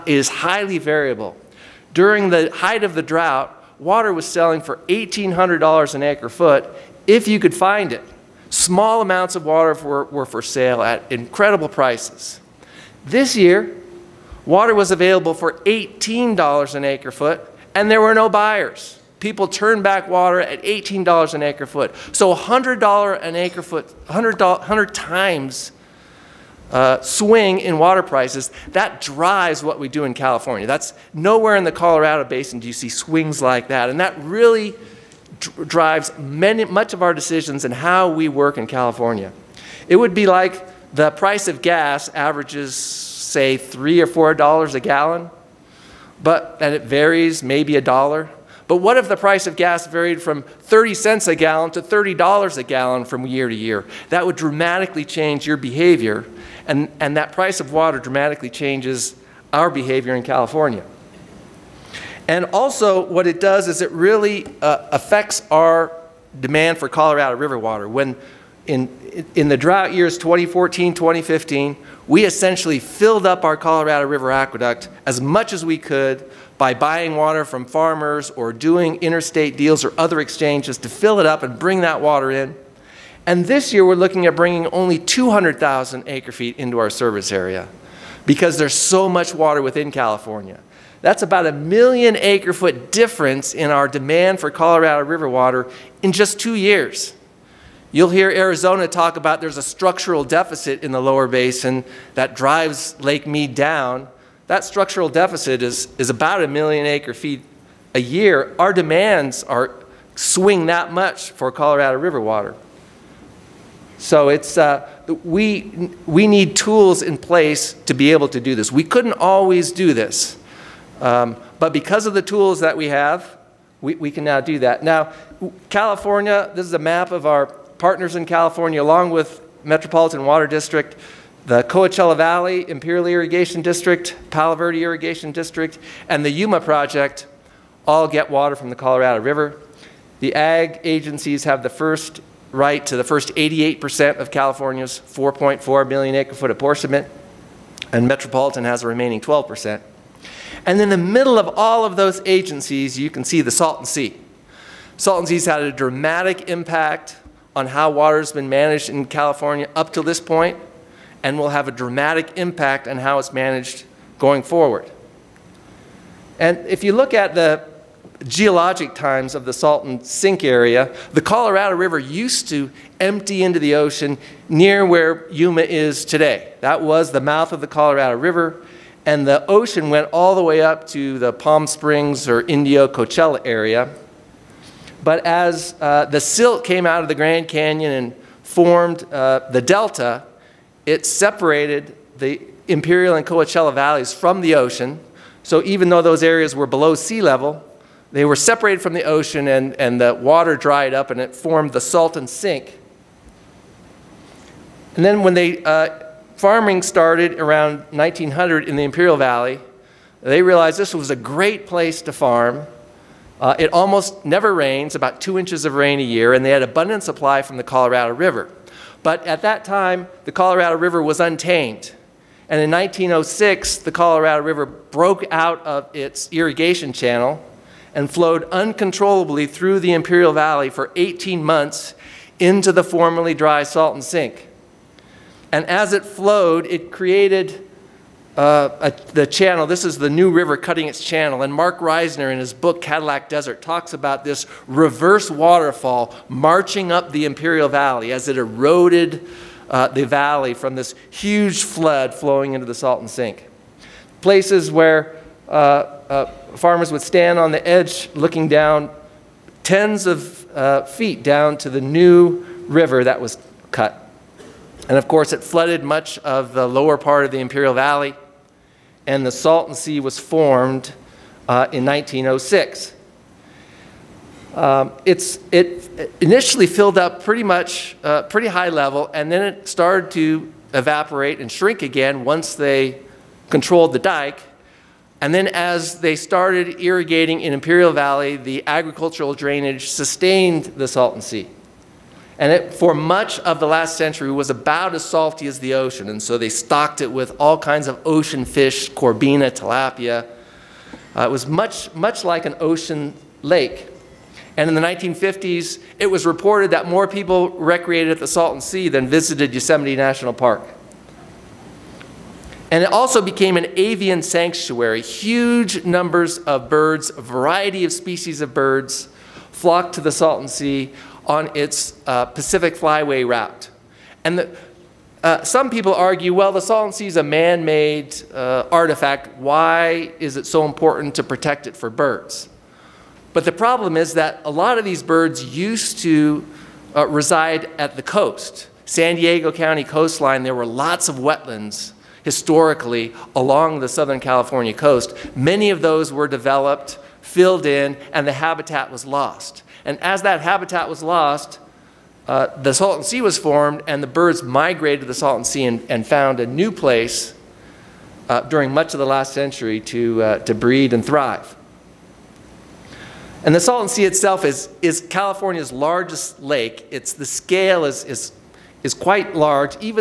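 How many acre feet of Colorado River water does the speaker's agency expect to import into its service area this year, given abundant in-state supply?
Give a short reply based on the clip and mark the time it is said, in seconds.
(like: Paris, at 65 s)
200,000 acre feet, at 84 s.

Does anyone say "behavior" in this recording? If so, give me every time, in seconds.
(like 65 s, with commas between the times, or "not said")
55 s, 59 s.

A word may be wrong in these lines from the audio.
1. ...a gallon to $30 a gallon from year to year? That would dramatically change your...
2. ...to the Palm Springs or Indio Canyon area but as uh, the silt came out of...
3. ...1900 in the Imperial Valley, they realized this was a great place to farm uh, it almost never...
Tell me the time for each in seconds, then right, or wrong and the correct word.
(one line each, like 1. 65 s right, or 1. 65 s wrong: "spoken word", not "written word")
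1. 51 s right
2. 180 s wrong: "Coachella", not "Canyon"
3. 207 s right.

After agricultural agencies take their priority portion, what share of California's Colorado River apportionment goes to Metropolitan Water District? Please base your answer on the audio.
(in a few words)
12%.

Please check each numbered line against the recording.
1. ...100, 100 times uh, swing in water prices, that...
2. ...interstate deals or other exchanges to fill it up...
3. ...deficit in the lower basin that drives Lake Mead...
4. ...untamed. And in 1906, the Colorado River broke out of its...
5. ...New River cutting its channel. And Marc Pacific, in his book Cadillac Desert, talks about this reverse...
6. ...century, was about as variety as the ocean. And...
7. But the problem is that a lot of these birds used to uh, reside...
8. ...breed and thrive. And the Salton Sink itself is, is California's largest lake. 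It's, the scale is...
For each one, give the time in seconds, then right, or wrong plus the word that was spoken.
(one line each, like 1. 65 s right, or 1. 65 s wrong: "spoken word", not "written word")
1. 24 s right
2. 78 s right
3. 100 s right
4. 221 s right
5. 240 s wrong: "Reisner", not "Pacific"
6. 293 s wrong: "salty", not "variety"
7. 333 s right
8. 360 s wrong: "Sea", not "Sink".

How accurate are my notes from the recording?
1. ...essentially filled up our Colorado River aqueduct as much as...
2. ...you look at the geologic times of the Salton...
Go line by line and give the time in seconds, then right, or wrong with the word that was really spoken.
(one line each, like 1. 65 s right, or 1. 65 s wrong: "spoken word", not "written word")
1. 72 s right
2. 166 s right.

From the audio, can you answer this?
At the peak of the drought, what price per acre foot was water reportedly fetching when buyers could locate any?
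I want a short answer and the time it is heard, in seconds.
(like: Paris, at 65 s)
$1,800, at 4 s.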